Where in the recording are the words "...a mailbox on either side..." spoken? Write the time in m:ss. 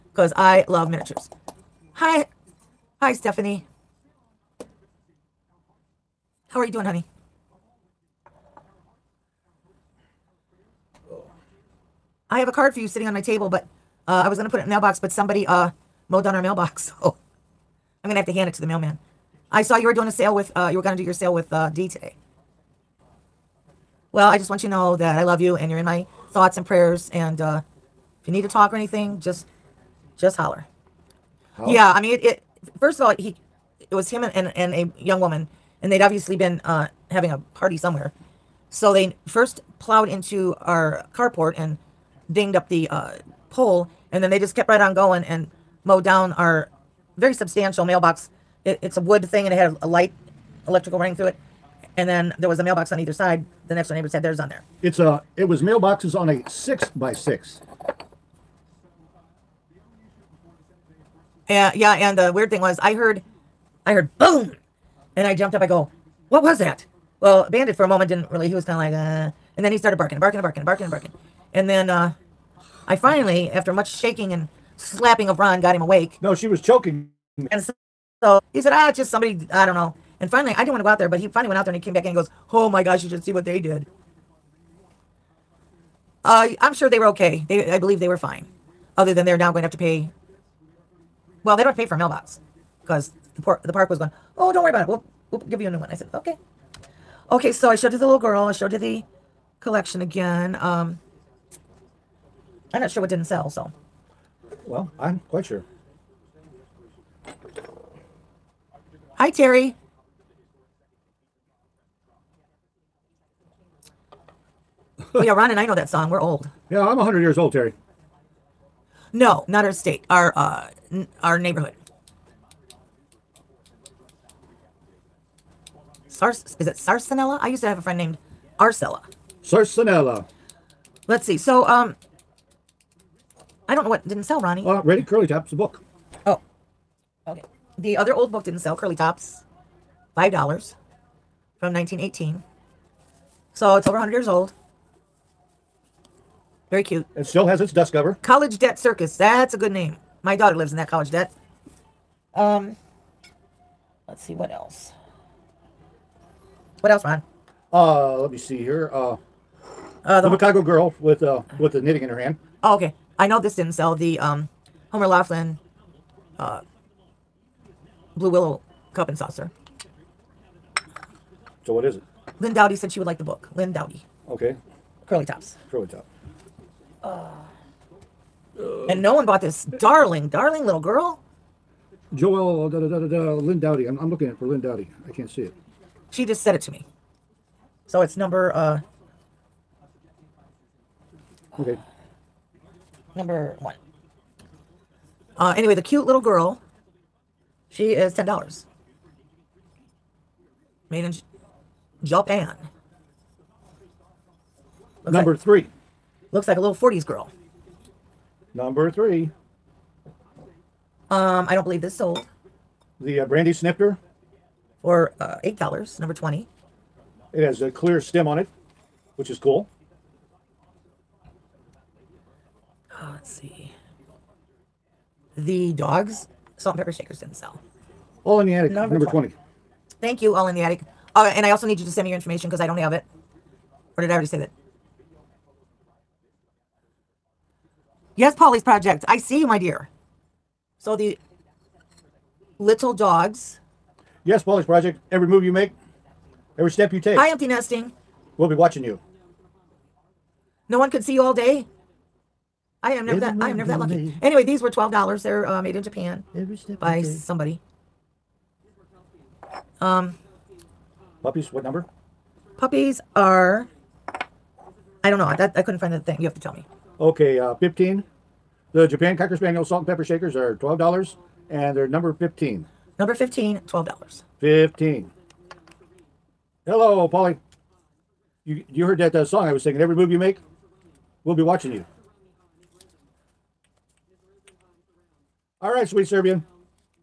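0:52.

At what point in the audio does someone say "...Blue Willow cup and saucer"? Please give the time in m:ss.
2:48.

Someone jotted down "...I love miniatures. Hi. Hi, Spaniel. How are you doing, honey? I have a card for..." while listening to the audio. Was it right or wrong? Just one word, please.
wrong.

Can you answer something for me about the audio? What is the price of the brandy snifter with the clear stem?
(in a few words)
$8.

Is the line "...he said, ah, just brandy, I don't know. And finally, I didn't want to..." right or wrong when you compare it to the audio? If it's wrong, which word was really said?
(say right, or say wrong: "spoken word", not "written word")
wrong: "somebody", not "brandy".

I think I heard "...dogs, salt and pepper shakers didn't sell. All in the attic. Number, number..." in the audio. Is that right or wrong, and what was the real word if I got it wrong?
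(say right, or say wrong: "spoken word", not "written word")
right.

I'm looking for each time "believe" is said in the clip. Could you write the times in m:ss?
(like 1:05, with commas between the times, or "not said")
1:27, 3:31.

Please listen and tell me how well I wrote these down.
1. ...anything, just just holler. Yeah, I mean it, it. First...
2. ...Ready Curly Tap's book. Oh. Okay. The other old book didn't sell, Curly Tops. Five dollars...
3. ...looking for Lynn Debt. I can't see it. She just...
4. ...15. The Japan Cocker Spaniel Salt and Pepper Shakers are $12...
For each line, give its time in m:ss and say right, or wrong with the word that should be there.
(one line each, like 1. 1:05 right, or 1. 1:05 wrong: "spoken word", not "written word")
1. 0:28 right
2. 2:14 right
3. 3:04 wrong: "Dowdy", not "Debt"
4. 4:27 right.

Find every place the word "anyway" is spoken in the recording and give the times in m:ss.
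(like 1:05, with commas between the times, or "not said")
3:15, 4:14.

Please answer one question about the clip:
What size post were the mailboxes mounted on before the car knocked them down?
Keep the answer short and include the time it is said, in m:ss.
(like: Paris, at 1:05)
6 by 6, at 0:56.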